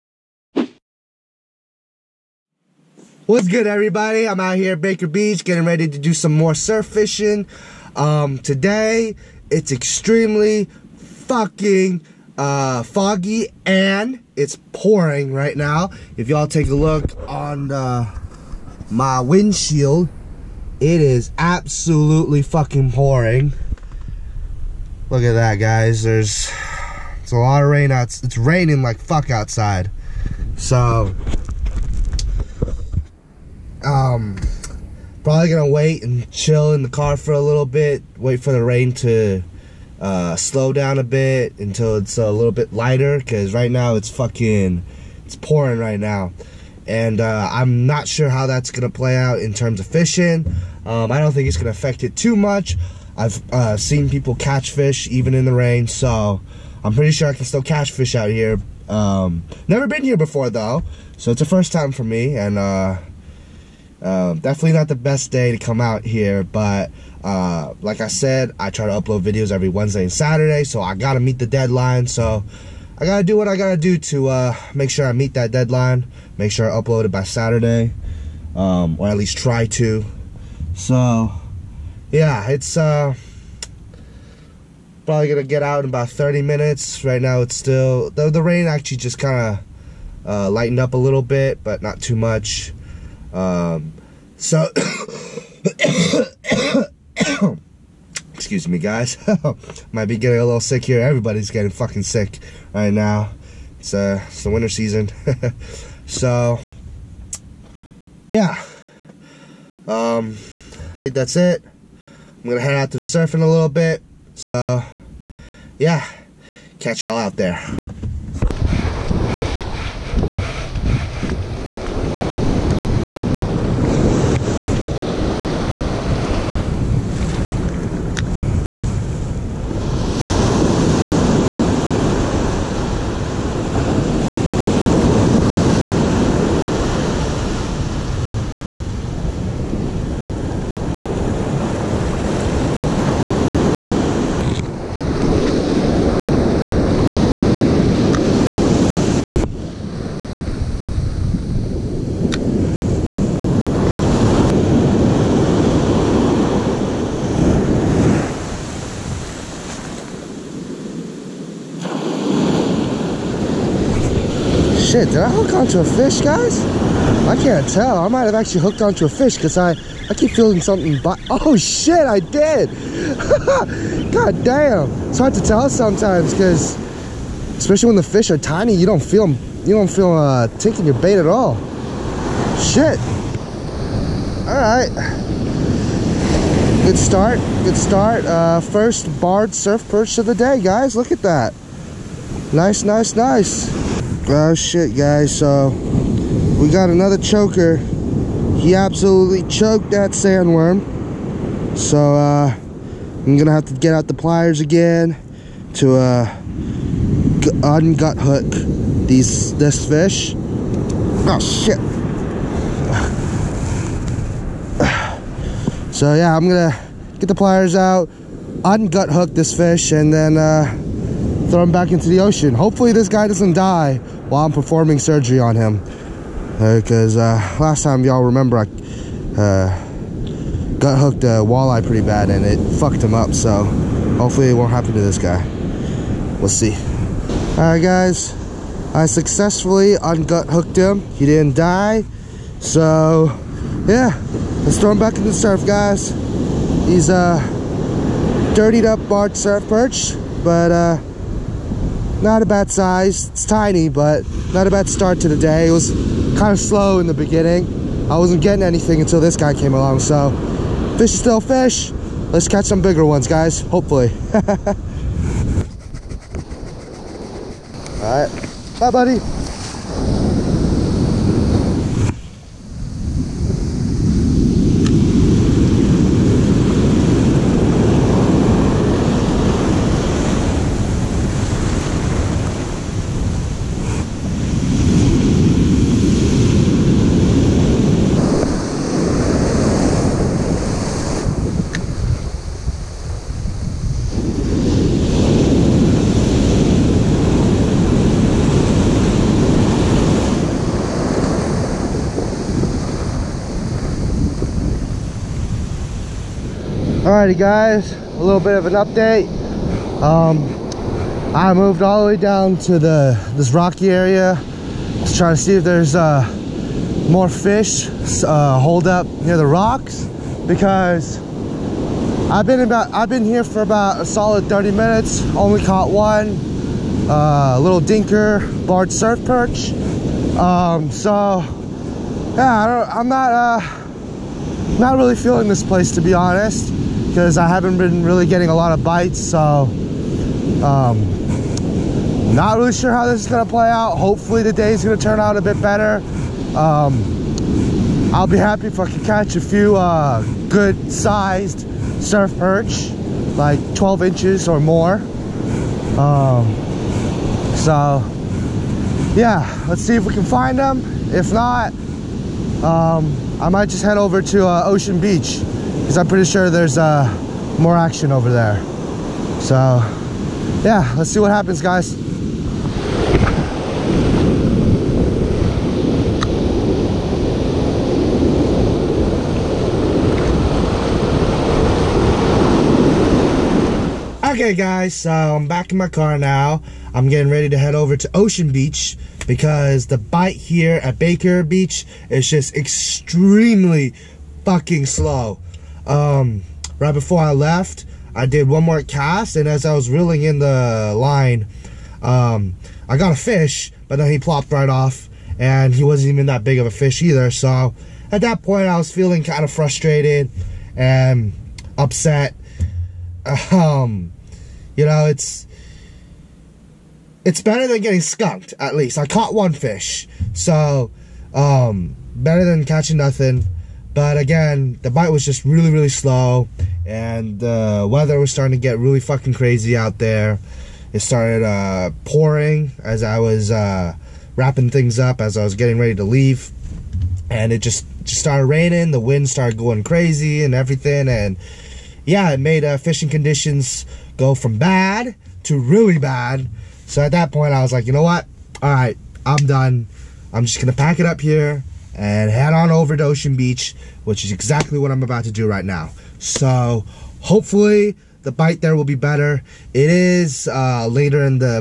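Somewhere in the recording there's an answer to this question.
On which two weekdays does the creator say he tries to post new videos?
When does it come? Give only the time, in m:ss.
1:09.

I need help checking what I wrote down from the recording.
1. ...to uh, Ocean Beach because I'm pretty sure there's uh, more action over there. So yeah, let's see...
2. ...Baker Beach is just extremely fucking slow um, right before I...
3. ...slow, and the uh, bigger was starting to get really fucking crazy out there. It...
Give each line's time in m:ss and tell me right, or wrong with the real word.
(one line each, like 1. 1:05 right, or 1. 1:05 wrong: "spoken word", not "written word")
1. 6:04 right
2. 6:30 right
3. 7:05 wrong: "weather", not "bigger".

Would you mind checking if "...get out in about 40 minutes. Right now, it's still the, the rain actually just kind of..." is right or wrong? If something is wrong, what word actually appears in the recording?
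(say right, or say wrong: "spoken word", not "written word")
wrong: "30", not "40".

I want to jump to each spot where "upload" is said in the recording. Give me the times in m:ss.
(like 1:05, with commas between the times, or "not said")
1:08, 1:16.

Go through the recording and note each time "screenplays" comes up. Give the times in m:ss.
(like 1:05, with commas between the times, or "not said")
not said.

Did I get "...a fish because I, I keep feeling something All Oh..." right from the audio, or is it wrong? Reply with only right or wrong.
wrong.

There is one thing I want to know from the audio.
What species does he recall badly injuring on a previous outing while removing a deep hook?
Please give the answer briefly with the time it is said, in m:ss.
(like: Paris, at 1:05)
Walleye, at 3:51.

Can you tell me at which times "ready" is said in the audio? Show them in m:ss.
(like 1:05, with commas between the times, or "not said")
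0:05, 6:27, 7:15.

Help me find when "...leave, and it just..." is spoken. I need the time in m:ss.
7:16.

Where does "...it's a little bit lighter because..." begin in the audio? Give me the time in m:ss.
0:41.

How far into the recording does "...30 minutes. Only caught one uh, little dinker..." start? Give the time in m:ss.
5:24.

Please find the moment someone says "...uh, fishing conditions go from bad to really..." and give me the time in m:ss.
7:22.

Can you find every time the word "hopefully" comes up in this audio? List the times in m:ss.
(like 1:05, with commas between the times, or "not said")
3:42, 3:54, 4:23, 5:43, 7:37.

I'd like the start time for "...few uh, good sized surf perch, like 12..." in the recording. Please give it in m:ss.
5:49.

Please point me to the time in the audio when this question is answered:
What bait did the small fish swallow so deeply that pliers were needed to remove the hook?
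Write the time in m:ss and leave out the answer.
3:20.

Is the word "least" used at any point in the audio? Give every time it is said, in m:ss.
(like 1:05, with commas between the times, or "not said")
1:19, 6:58.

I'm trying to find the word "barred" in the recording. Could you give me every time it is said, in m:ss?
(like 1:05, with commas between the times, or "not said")
3:09, 4:09, 5:28.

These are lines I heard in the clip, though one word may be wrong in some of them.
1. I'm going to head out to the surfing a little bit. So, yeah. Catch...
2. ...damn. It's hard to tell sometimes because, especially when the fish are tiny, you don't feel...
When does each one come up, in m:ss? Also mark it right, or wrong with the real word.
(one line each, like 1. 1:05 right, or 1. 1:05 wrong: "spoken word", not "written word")
1. 1:51 right
2. 2:54 right.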